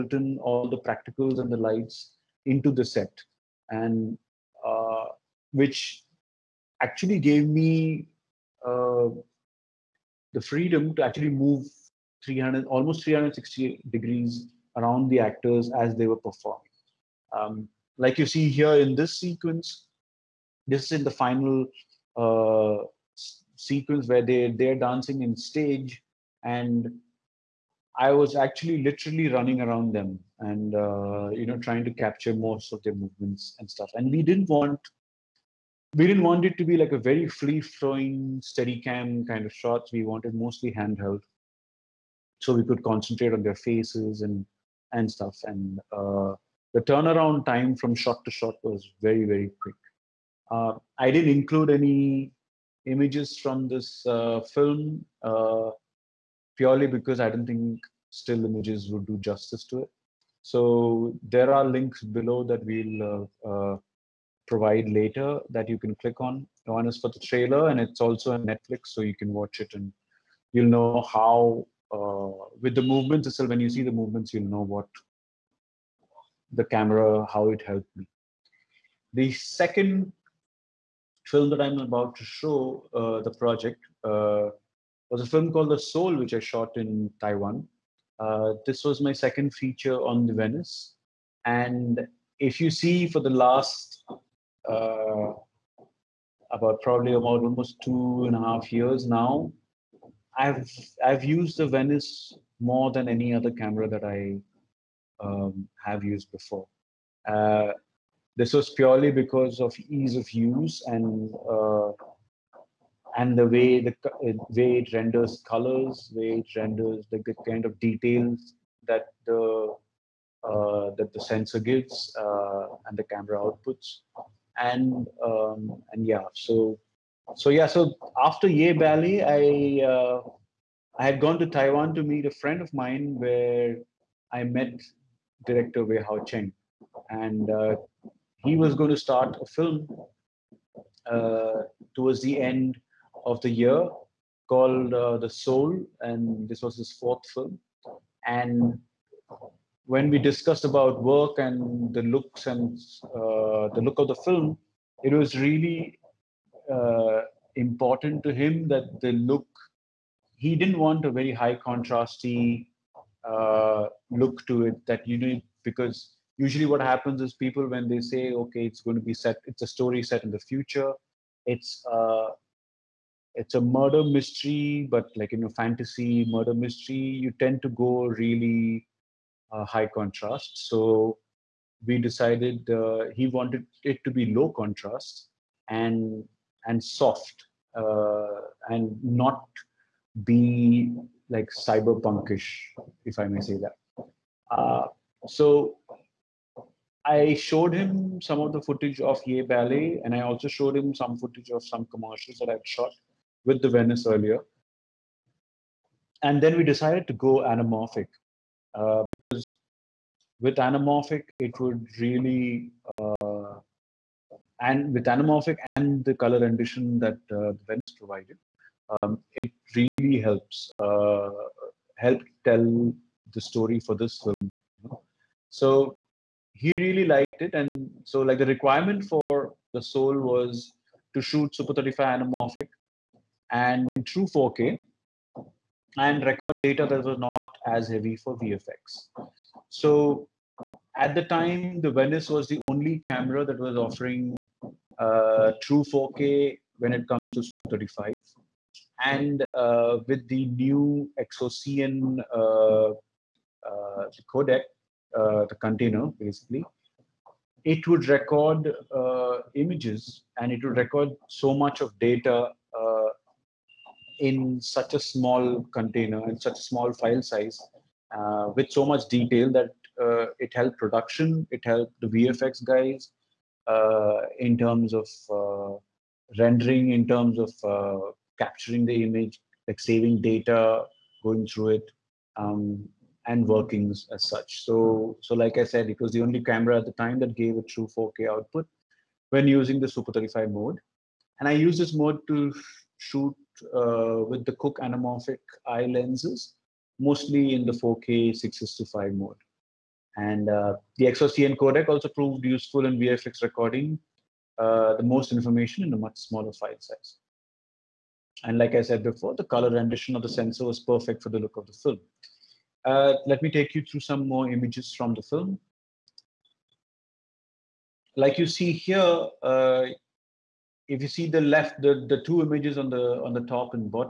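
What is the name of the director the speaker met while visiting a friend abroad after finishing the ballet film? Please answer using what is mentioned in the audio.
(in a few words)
Wei Hao Cheng.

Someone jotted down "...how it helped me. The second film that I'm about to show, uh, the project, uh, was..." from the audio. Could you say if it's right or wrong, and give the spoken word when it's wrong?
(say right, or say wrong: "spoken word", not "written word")
right.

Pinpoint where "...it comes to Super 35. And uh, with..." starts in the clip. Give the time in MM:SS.
04:06.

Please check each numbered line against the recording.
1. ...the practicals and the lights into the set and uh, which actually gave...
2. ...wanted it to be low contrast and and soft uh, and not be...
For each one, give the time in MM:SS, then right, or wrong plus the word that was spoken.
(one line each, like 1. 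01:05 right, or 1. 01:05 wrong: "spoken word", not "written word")
1. 00:00 right
2. 03:03 right.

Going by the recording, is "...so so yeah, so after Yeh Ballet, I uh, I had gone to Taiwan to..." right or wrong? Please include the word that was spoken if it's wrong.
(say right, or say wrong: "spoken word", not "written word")
right.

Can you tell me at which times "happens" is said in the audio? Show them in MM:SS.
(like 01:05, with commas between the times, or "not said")
02:46.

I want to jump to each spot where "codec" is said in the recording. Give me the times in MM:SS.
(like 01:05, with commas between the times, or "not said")
04:14, 05:01.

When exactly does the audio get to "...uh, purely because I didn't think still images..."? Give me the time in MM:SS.
00:55.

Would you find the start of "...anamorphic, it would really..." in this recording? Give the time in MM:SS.
03:30.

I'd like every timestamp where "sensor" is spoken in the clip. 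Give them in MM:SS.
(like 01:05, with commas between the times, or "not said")
02:01, 05:10.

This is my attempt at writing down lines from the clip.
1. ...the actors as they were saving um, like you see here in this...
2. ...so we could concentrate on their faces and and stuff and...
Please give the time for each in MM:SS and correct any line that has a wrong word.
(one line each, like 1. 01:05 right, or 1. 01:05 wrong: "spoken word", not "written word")
1. 00:15 wrong: "performing", not "saving"
2. 00:42 right.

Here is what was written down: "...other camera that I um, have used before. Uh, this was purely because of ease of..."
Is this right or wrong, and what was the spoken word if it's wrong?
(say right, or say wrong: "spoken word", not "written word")
right.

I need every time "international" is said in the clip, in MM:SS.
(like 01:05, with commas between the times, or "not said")
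not said.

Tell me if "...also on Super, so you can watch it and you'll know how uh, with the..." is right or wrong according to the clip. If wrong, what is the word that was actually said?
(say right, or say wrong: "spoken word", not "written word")
wrong: "Netflix", not "Super".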